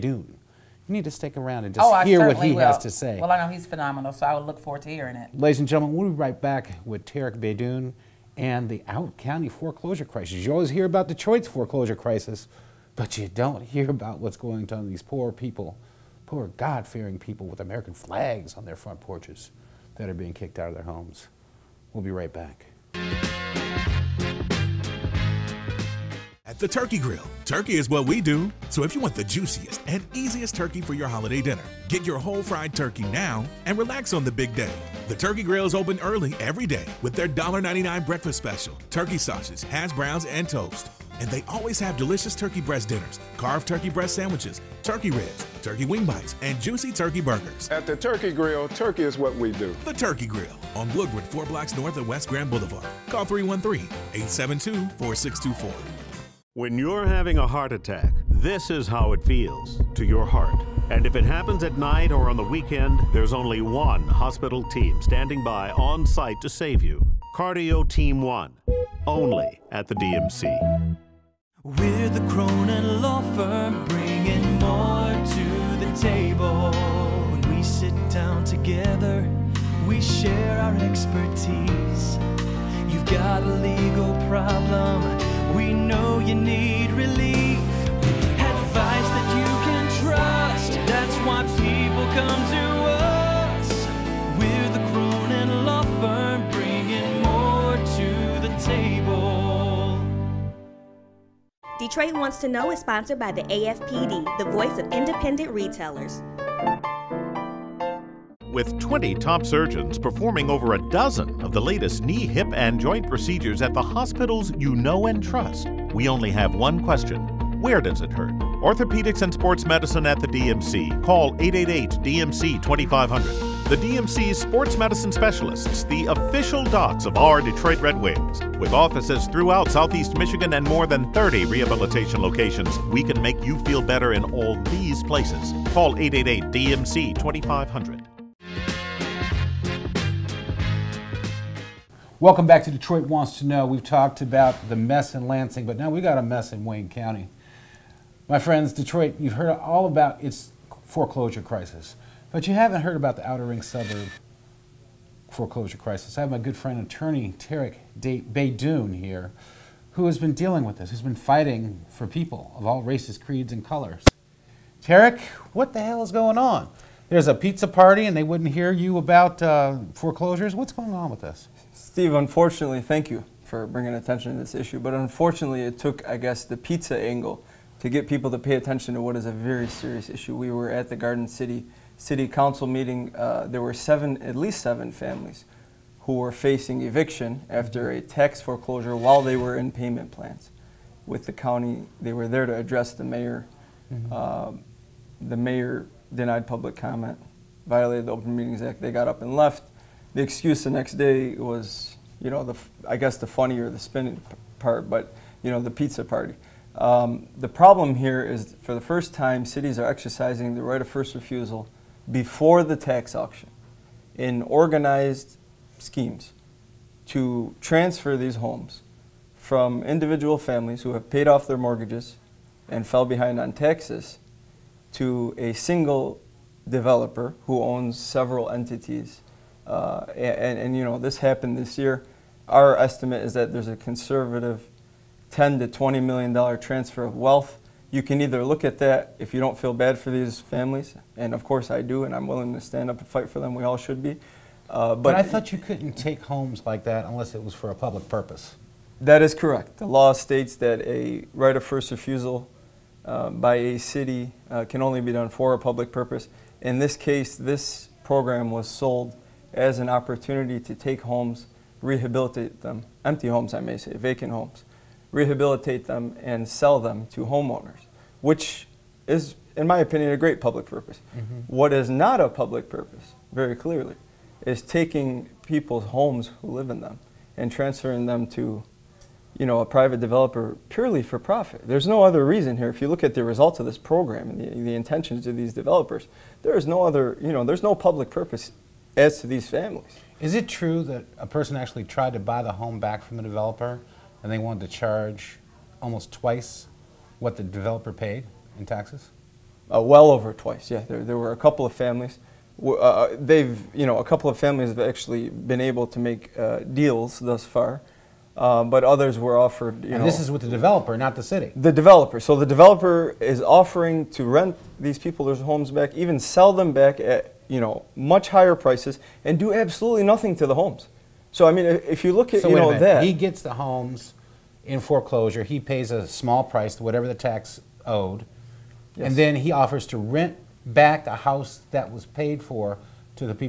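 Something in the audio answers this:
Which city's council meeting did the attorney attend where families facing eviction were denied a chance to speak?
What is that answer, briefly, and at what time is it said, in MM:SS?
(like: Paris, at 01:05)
Garden City, at 03:00.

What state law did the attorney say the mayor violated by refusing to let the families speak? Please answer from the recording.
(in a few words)
Open Meetings Act.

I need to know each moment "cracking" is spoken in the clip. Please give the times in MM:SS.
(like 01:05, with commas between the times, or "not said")
not said.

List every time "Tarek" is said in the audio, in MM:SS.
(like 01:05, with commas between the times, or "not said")
00:07, 02:37, 02:44.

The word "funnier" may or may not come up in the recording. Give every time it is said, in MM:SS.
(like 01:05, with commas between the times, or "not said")
03:23.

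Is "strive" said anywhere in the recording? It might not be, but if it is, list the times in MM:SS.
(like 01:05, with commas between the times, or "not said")
not said.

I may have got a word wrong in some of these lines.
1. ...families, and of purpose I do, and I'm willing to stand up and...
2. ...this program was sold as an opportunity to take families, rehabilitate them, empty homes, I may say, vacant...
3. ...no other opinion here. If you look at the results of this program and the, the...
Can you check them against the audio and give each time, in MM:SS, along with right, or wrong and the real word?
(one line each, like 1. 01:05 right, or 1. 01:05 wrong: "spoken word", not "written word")
1. 04:00 wrong: "course", not "purpose"
2. 04:17 wrong: "homes", not "families"
3. 04:41 wrong: "reason", not "opinion".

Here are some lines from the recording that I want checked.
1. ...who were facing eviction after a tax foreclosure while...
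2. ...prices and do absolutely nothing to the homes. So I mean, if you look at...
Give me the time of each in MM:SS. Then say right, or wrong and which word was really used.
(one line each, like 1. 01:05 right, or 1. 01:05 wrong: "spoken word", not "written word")
1. 03:06 right
2. 05:18 right.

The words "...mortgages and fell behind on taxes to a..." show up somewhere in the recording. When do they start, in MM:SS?
03:41.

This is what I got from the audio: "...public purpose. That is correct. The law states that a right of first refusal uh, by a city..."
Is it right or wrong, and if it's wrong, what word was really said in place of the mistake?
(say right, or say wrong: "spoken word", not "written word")
right.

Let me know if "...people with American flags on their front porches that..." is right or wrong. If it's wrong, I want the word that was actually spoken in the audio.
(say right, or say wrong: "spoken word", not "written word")
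right.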